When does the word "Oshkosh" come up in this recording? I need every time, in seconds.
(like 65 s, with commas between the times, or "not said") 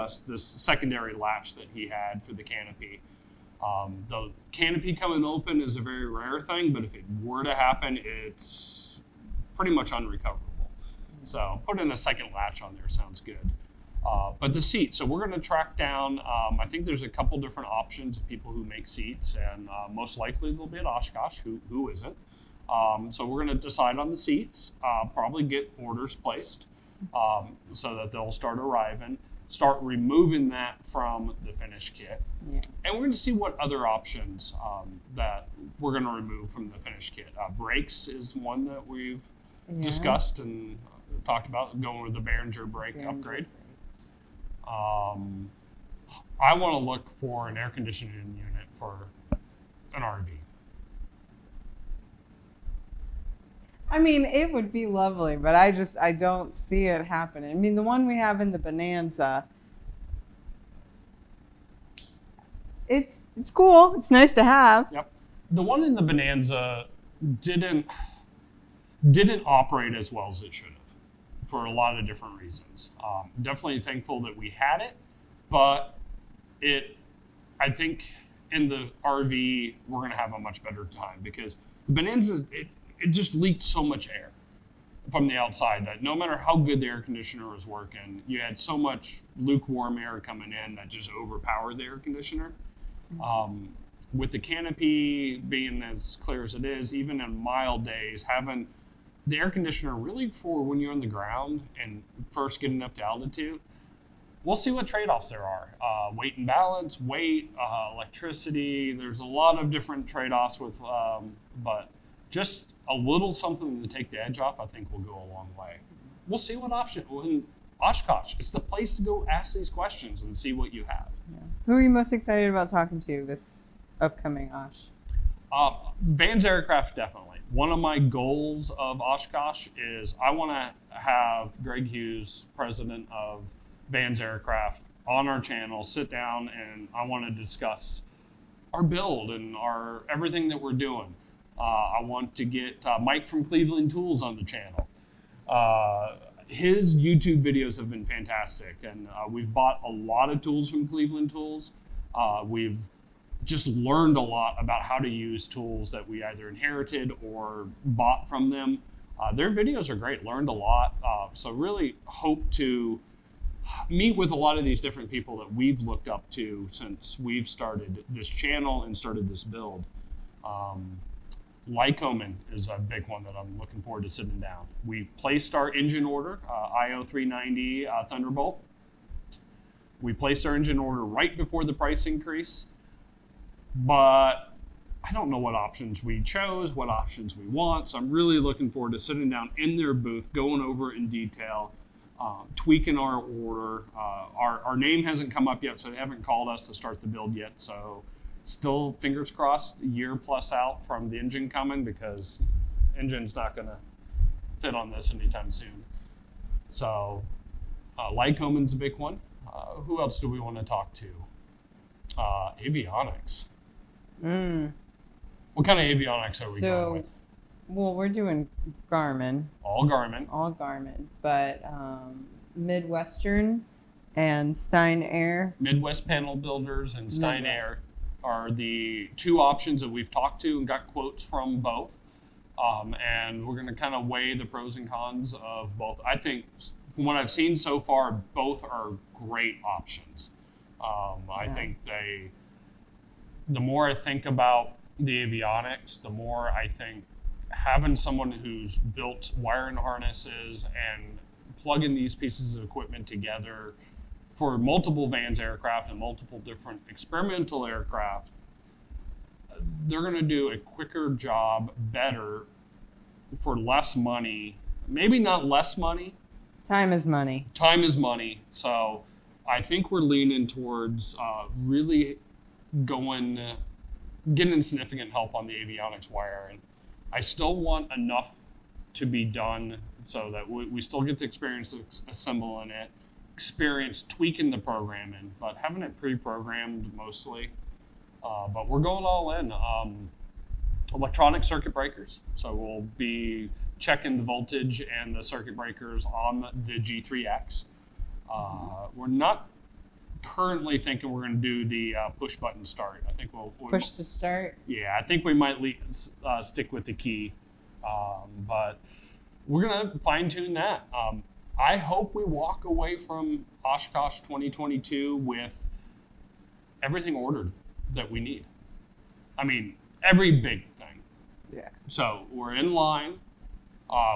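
20 s, 117 s, 129 s, 313 s.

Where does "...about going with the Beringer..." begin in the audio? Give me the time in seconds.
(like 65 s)
41 s.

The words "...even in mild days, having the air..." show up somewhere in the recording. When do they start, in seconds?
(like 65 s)
96 s.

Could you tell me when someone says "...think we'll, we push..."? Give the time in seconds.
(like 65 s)
303 s.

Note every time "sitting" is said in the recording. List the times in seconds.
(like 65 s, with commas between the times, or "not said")
174 s, 188 s.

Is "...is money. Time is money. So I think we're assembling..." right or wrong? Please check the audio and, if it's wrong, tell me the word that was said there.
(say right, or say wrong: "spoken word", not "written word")
wrong: "leaning", not "assembling".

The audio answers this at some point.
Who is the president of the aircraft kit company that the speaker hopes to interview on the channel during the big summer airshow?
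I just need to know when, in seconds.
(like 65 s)
131 s.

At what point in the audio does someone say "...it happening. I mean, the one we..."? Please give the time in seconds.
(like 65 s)
56 s.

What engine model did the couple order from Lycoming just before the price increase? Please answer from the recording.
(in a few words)
IO390 Thunderbolt.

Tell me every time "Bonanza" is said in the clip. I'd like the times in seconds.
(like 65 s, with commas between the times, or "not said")
58 s, 66 s, 81 s.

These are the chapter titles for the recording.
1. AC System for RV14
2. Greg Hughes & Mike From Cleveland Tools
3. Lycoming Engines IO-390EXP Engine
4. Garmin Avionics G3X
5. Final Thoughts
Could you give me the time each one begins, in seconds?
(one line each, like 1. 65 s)
1. 46 s
2. 122 s
3. 171 s
4. 207 s
5. 312 s.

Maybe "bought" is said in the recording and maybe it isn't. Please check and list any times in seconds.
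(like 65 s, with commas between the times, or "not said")
149 s, 157 s.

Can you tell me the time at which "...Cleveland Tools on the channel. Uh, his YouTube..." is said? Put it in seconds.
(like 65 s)
143 s.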